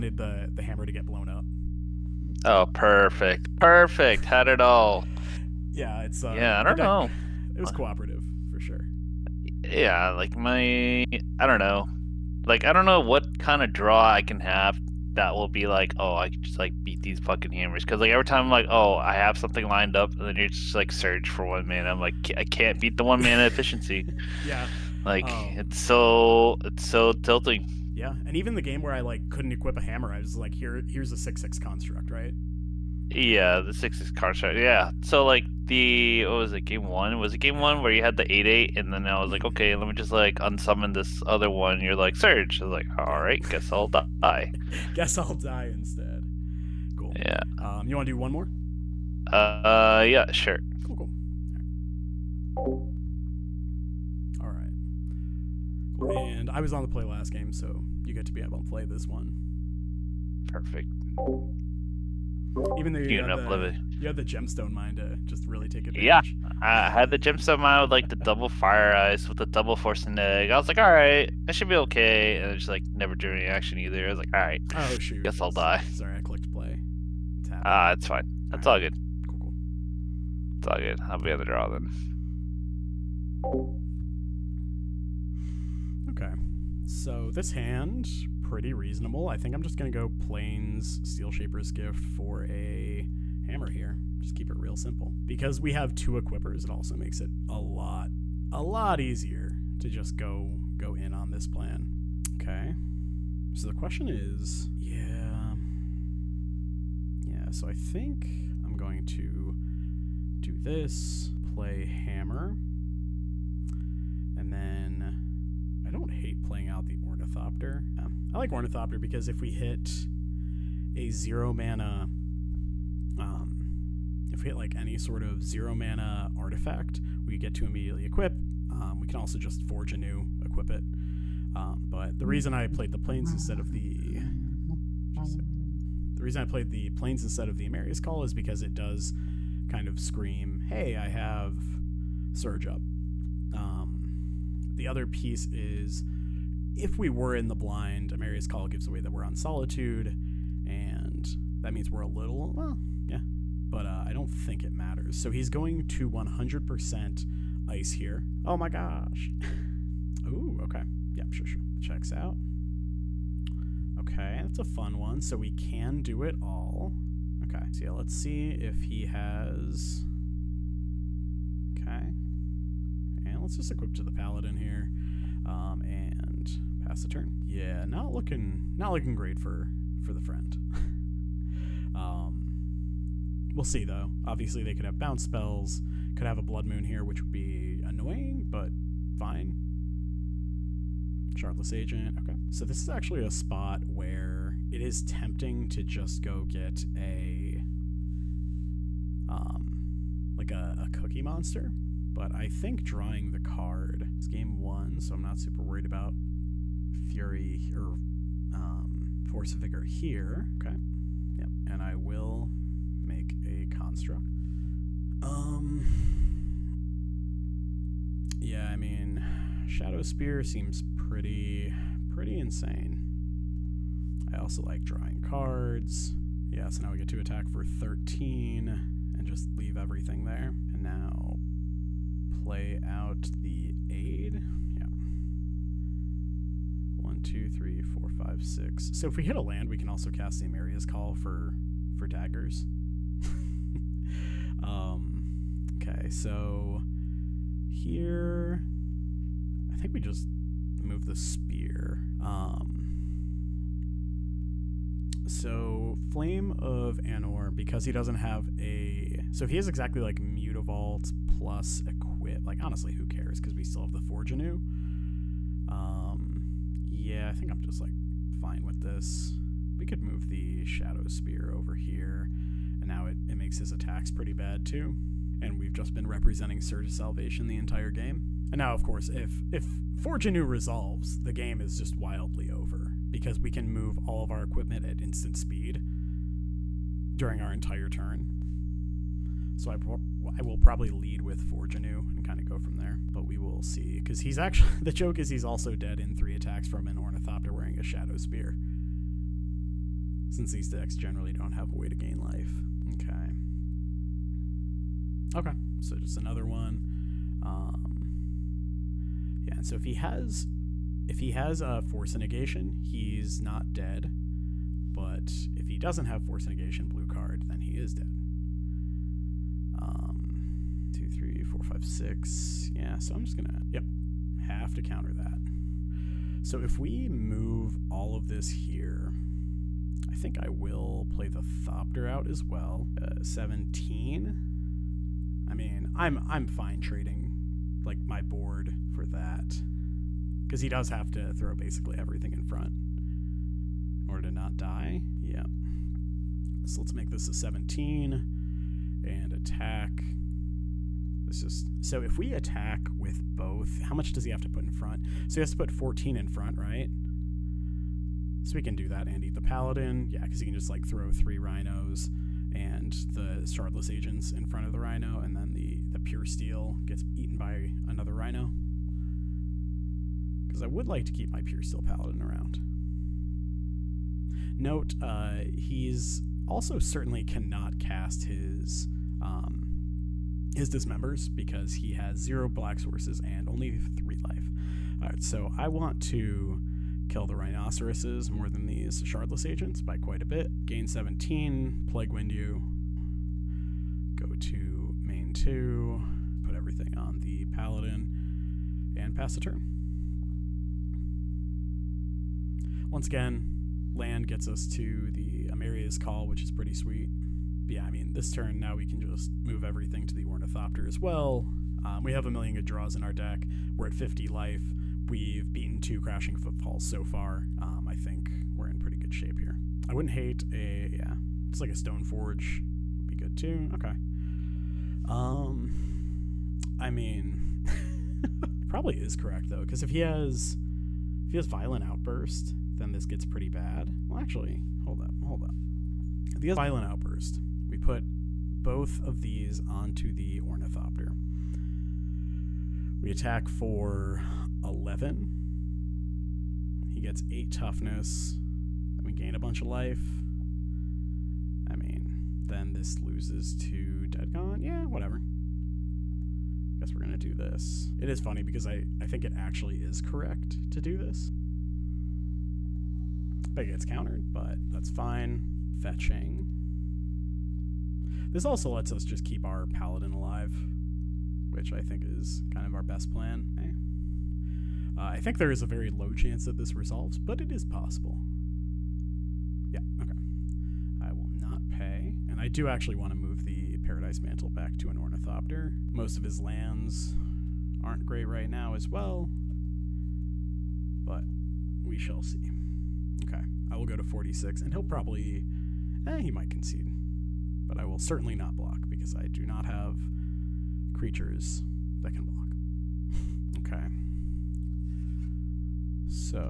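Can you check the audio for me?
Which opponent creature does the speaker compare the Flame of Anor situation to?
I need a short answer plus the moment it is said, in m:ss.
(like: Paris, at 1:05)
Mutavault, at 4:20.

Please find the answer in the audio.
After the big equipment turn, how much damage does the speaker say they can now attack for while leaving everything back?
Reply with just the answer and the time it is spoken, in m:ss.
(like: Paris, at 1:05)
13, at 3:47.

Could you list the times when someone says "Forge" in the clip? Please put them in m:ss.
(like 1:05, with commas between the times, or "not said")
2:09, 4:23, 4:39, 4:51, 7:02.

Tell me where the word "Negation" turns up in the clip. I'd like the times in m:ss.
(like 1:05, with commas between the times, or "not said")
5:12, 5:16.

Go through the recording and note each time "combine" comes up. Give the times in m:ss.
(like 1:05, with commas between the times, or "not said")
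not said.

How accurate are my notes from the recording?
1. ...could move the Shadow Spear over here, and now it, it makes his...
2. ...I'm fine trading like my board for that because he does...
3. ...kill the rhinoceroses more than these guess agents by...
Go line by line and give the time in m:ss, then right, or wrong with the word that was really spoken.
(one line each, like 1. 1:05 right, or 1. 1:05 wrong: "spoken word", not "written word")
1. 4:29 right
2. 5:36 right
3. 6:27 wrong: "shardless", not "guess".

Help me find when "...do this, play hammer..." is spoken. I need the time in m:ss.
1:50.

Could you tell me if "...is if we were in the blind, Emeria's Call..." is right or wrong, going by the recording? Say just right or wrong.
right.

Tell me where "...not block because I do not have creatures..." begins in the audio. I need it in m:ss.
8:18.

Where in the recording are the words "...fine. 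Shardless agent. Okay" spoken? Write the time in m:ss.
3:09.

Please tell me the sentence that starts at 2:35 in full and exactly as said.
So he's going to 100% ice here.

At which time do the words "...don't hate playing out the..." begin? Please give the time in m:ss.
1:55.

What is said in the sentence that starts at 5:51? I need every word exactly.
This is so if we attack with both, how much does he have to put in front?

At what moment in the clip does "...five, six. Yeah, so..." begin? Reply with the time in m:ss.
5:21.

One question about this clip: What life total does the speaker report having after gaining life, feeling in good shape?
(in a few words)
50.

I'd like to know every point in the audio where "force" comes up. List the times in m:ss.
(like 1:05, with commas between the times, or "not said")
1:09, 3:29, 5:11, 5:16.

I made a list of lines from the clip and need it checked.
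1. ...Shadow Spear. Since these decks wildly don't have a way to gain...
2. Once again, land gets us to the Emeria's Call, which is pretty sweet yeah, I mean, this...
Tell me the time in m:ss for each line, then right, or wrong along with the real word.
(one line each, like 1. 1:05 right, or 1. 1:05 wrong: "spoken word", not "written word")
1. 4:57 wrong: "generally", not "wildly"
2. 6:42 right.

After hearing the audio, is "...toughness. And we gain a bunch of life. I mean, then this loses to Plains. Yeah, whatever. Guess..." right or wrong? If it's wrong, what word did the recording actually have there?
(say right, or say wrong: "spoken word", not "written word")
wrong: "Deadgon", not "Plains".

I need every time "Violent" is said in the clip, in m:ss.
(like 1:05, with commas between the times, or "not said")
7:11, 7:16.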